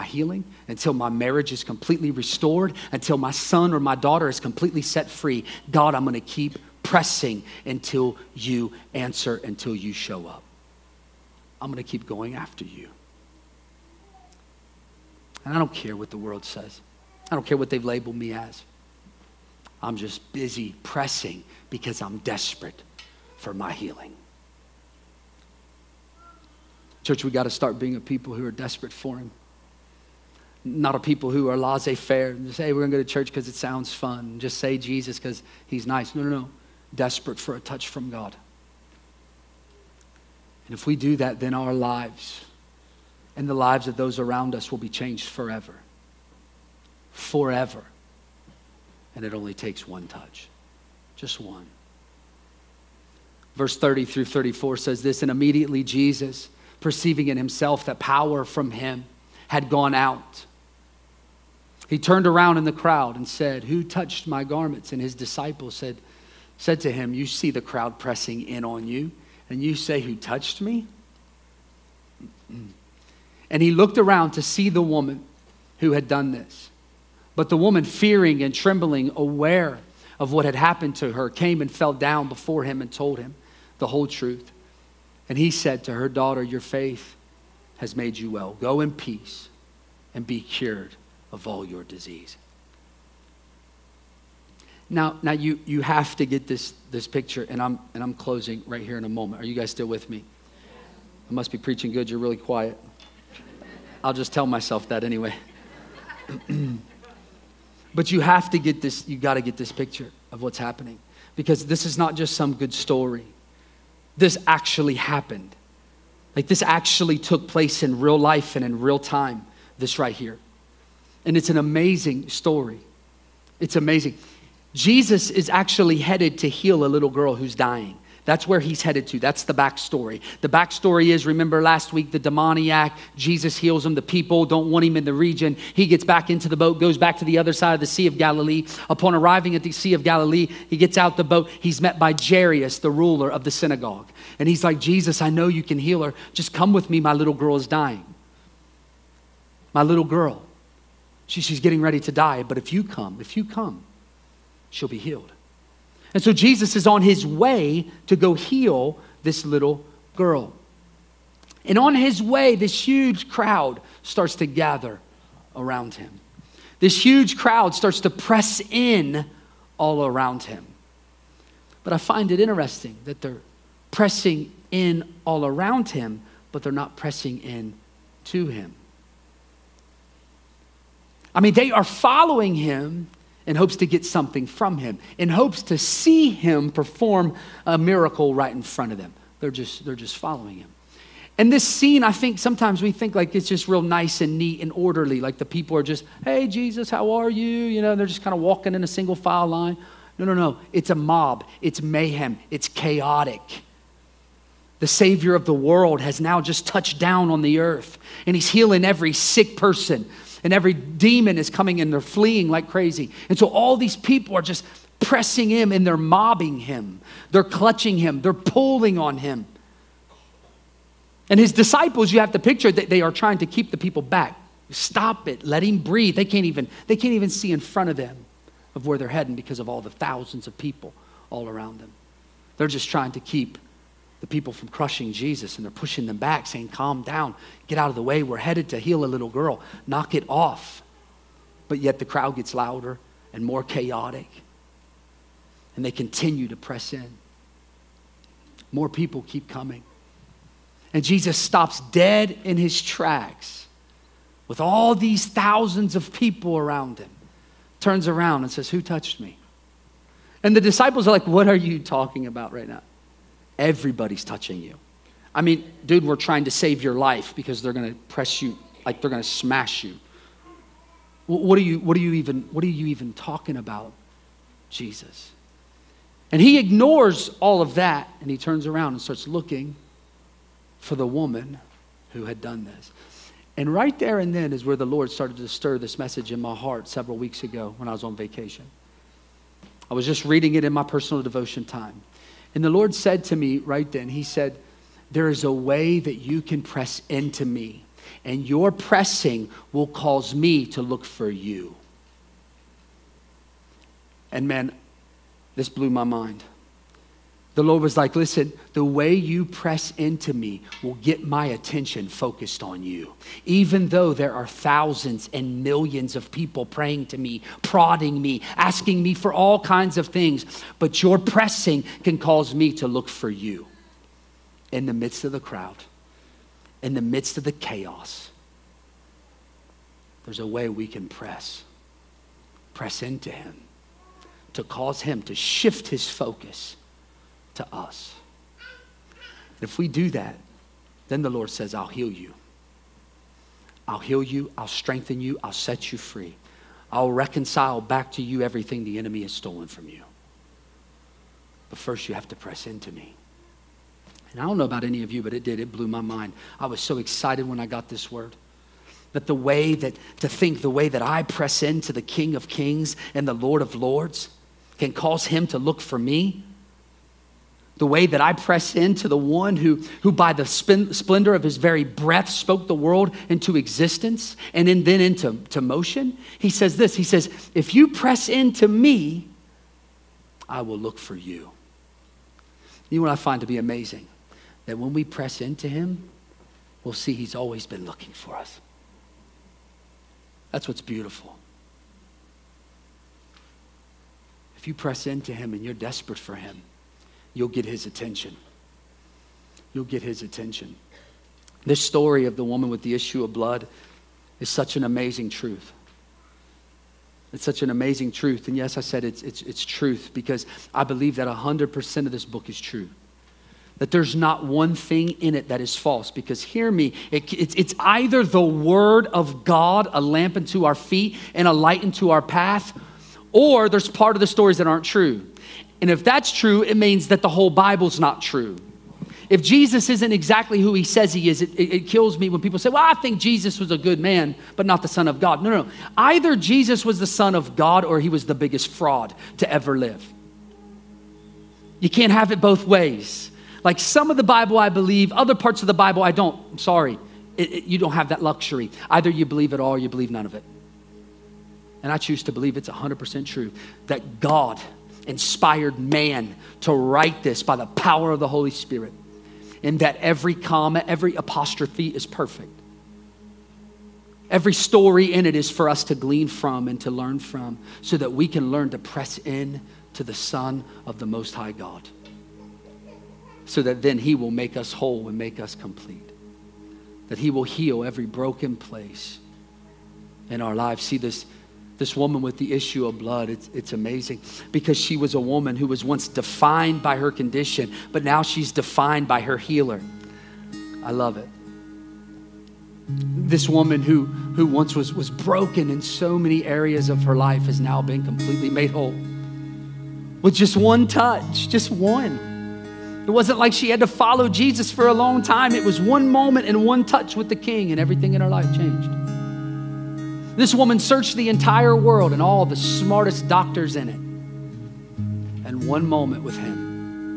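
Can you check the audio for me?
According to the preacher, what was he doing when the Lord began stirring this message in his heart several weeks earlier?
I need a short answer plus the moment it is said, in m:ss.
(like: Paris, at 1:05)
on vacation, at 4:47.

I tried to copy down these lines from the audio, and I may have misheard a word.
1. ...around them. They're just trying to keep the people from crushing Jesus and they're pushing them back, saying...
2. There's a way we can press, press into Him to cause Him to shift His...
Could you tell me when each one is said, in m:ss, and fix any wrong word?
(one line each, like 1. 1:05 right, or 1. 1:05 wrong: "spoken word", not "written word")
1. 3:51 right
2. 5:30 right.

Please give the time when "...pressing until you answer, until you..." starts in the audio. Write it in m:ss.
0:06.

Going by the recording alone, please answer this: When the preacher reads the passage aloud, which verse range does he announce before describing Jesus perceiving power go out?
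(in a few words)
30 through 34.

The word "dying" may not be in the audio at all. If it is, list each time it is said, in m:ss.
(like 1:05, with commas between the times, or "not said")
2:07, 2:27.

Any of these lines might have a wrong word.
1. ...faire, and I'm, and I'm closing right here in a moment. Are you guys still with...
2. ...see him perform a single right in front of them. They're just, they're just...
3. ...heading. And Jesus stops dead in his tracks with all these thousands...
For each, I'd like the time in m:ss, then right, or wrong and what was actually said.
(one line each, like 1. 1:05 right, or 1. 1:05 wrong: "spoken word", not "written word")
1. 1:37 wrong: "picture", not "faire"
2. 3:05 wrong: "miracle", not "single"
3. 4:09 wrong: "coming", not "heading".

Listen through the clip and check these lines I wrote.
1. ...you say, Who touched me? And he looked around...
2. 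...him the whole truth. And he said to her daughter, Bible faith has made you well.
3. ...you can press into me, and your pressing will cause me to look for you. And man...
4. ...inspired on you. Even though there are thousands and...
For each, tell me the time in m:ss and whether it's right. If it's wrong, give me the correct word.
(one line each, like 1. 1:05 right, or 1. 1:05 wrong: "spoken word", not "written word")
1. 1:09 right
2. 1:23 wrong: "Your", not "Bible"
3. 4:56 right
4. 5:12 wrong: "focused", not "inspired".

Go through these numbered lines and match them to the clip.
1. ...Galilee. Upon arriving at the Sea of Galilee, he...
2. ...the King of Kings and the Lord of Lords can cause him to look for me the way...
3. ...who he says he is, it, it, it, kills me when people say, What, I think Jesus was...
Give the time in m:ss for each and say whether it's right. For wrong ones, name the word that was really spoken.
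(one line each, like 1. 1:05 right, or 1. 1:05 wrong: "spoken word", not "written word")
1. 2:18 right
2. 6:01 right
3. 7:10 wrong: "Well", not "What".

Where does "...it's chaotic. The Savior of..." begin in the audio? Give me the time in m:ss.
3:22.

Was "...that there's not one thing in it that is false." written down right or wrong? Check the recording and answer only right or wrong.
right.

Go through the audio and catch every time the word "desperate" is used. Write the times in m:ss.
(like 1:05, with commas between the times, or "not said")
0:22, 0:28, 0:36, 6:35.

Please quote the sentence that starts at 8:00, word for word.
See, this, this woman with the issue of blood.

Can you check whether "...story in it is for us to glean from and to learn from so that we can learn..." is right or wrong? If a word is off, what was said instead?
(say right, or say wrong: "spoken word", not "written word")
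right.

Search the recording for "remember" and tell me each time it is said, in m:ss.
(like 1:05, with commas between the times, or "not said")
2:11.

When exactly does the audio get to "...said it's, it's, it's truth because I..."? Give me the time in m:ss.
6:48.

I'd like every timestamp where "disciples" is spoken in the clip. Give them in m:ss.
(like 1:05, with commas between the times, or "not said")
1:05, 3:41, 4:20.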